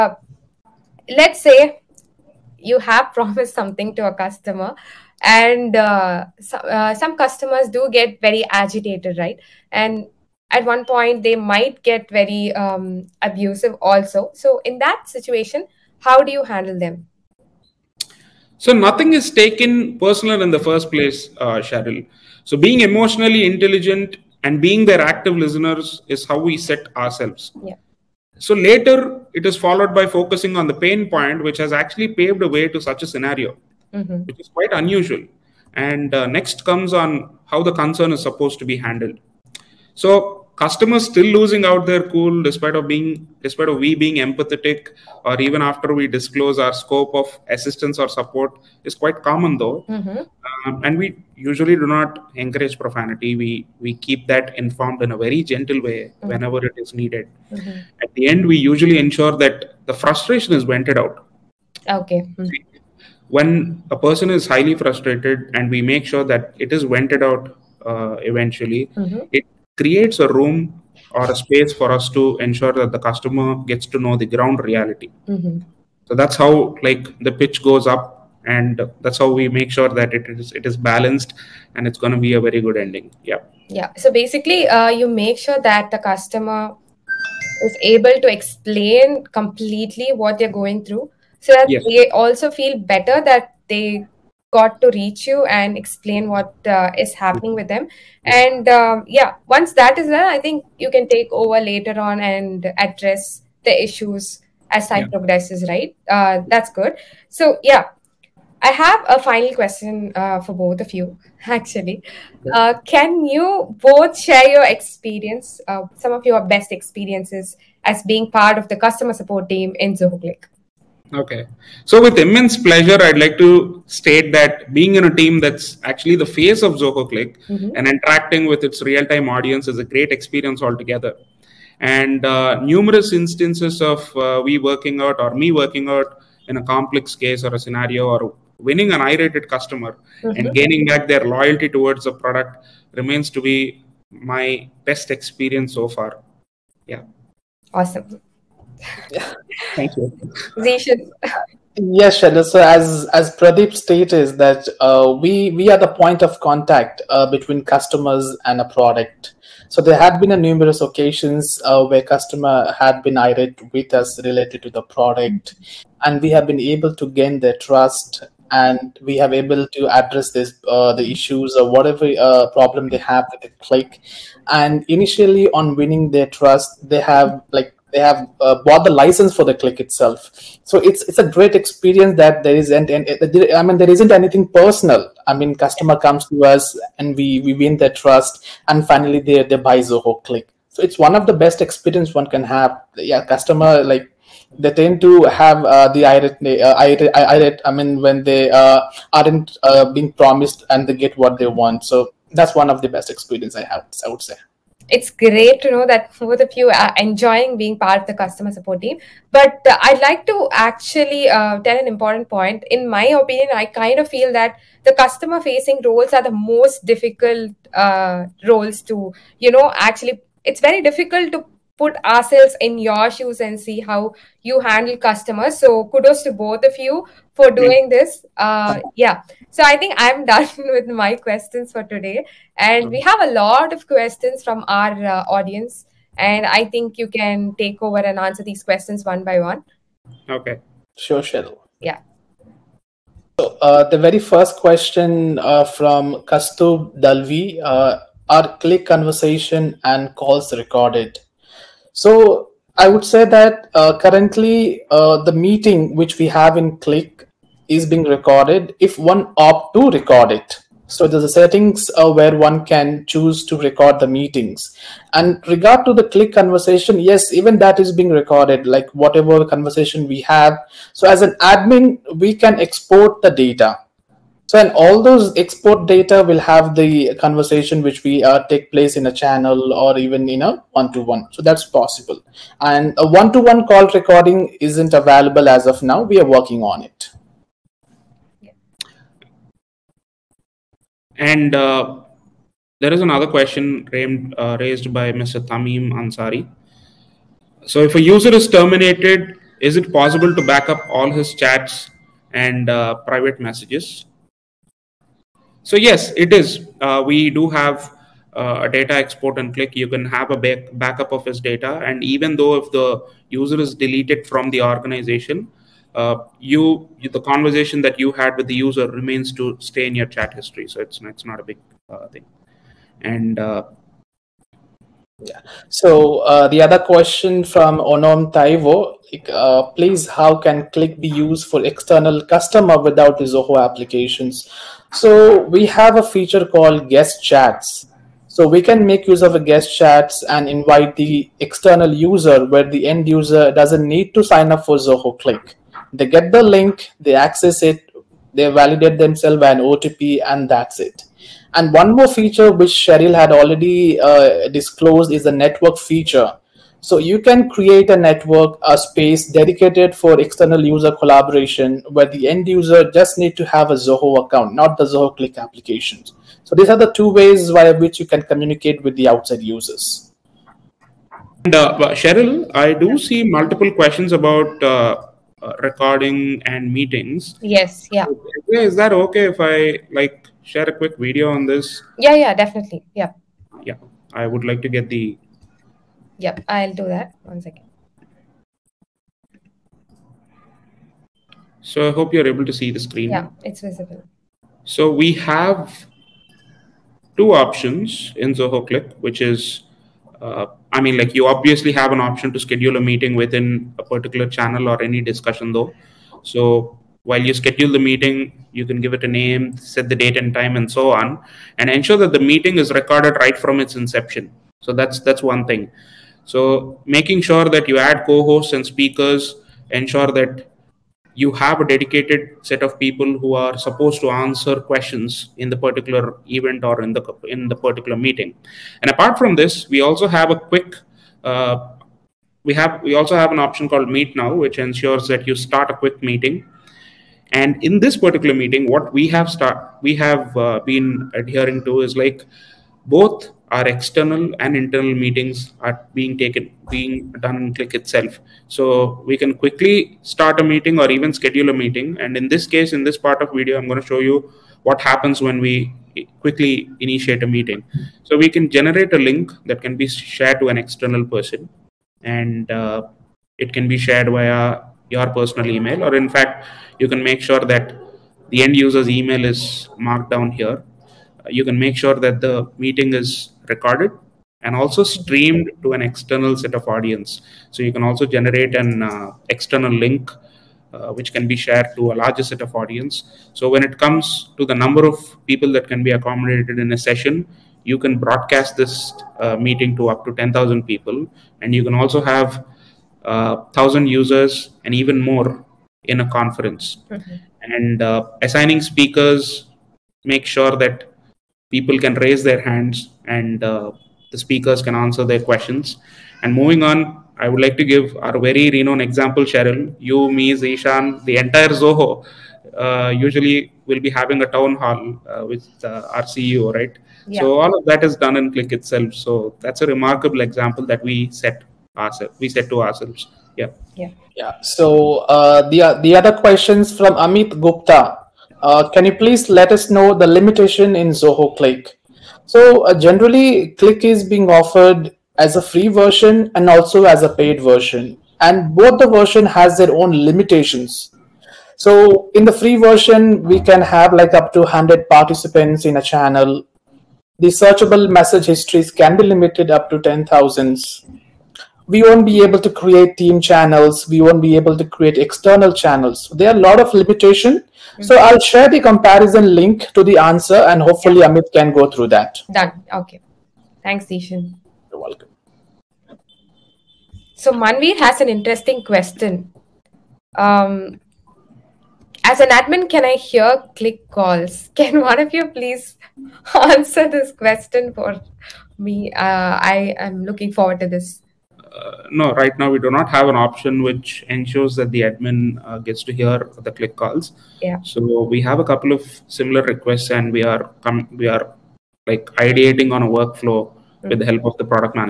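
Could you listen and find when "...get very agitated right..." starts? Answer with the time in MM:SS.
00:07.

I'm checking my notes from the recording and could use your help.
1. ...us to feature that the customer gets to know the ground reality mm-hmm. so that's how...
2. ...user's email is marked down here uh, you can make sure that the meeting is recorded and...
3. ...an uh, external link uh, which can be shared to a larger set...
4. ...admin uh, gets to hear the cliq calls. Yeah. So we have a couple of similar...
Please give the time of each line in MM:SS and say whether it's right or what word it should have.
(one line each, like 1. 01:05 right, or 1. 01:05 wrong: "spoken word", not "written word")
1. 01:11 wrong: "ensure", not "feature"
2. 07:48 right
3. 07:58 right
4. 09:44 right.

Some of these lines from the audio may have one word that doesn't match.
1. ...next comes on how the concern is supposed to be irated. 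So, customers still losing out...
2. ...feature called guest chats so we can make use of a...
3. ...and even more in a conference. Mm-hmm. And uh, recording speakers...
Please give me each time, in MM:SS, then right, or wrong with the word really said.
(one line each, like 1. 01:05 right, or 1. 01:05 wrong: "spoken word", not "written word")
1. 00:36 wrong: "handled", not "irated"
2. 05:36 right
3. 08:14 wrong: "assigning", not "recording".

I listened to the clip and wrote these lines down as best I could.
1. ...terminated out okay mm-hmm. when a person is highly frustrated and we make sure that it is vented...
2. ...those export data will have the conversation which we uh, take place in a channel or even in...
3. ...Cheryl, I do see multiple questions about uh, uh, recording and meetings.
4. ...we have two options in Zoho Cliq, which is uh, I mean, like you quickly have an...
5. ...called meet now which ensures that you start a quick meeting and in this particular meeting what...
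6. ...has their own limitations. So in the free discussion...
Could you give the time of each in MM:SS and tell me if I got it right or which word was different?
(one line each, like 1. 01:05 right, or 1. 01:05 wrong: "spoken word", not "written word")
1. 01:00 wrong: "vented", not "terminated"
2. 04:35 right
3. 06:11 right
4. 06:34 wrong: "obviously", not "quickly"
5. 07:13 right
6. 08:59 wrong: "version", not "discussion".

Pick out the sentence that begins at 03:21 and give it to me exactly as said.
So that's one of the best experience I have.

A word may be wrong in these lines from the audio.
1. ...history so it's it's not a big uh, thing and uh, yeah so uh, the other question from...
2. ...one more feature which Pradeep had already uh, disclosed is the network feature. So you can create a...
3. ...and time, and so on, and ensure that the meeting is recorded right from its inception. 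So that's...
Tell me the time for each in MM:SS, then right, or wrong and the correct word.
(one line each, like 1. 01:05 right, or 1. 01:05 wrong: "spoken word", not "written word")
1. 05:20 right
2. 05:51 wrong: "Cheryl", not "Pradeep"
3. 06:50 right.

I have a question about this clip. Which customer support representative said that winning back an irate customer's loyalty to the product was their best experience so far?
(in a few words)
Pradeep.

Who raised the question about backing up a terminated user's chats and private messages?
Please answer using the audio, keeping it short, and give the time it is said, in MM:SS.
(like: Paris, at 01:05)
Tamim Ansari, at 04:55.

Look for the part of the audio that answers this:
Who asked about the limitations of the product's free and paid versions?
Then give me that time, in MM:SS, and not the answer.
08:46.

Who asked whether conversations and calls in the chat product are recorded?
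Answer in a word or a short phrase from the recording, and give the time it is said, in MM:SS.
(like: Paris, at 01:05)
Kastub Dalvi, at 04:06.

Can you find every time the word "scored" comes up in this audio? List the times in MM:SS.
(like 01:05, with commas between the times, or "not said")
not said.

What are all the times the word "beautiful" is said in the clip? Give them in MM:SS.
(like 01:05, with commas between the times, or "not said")
not said.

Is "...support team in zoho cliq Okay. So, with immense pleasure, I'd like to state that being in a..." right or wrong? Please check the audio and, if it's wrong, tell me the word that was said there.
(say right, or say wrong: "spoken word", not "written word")
right.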